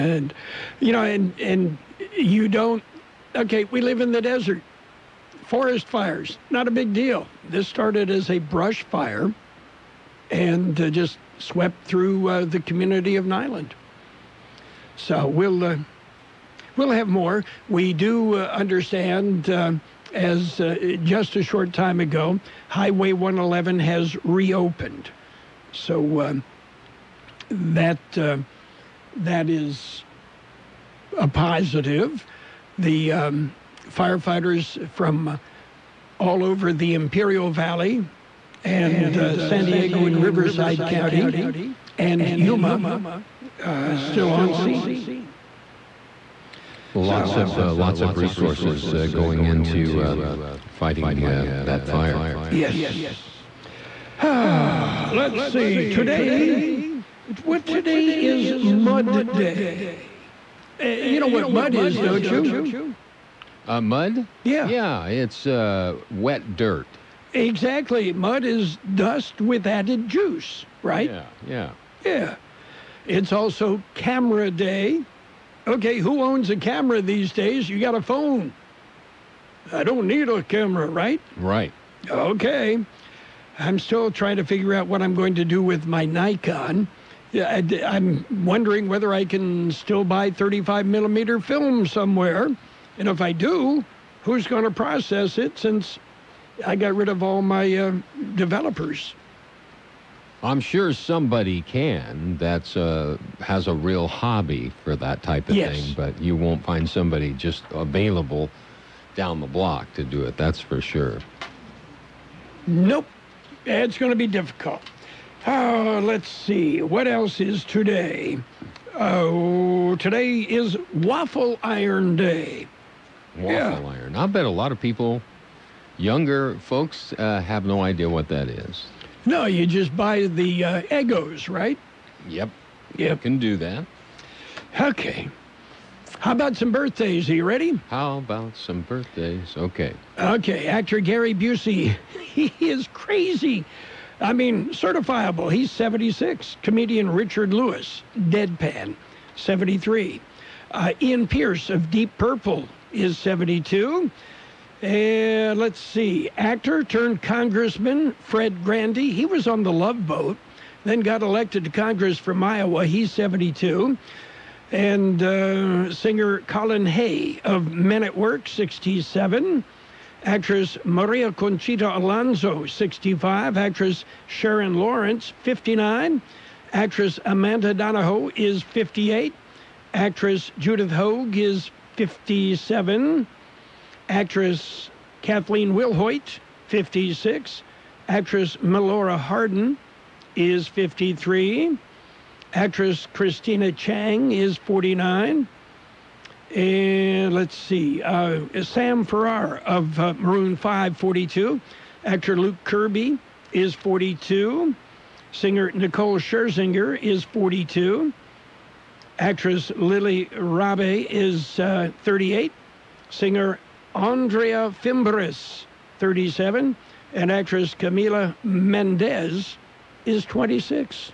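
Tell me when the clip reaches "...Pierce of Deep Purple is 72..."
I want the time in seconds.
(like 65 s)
151 s.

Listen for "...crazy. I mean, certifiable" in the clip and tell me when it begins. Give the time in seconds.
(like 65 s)
142 s.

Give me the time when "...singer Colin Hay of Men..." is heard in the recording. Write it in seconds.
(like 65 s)
165 s.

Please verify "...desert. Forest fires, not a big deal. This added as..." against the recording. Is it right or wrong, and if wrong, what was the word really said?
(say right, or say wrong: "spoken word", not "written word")
wrong: "started", not "added".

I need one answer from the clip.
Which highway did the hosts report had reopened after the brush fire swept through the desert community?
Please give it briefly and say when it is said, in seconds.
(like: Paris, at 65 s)
Highway 111, at 22 s.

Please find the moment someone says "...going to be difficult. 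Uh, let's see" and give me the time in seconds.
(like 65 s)
113 s.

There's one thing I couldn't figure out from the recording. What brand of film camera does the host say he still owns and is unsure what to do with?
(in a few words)
Nikon.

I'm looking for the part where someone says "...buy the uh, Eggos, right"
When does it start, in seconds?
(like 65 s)
129 s.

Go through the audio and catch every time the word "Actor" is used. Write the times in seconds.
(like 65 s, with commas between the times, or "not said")
140 s, 156 s, 202 s.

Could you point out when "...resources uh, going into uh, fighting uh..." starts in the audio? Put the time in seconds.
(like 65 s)
48 s.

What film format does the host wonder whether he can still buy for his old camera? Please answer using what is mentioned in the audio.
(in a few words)
35 millimeter.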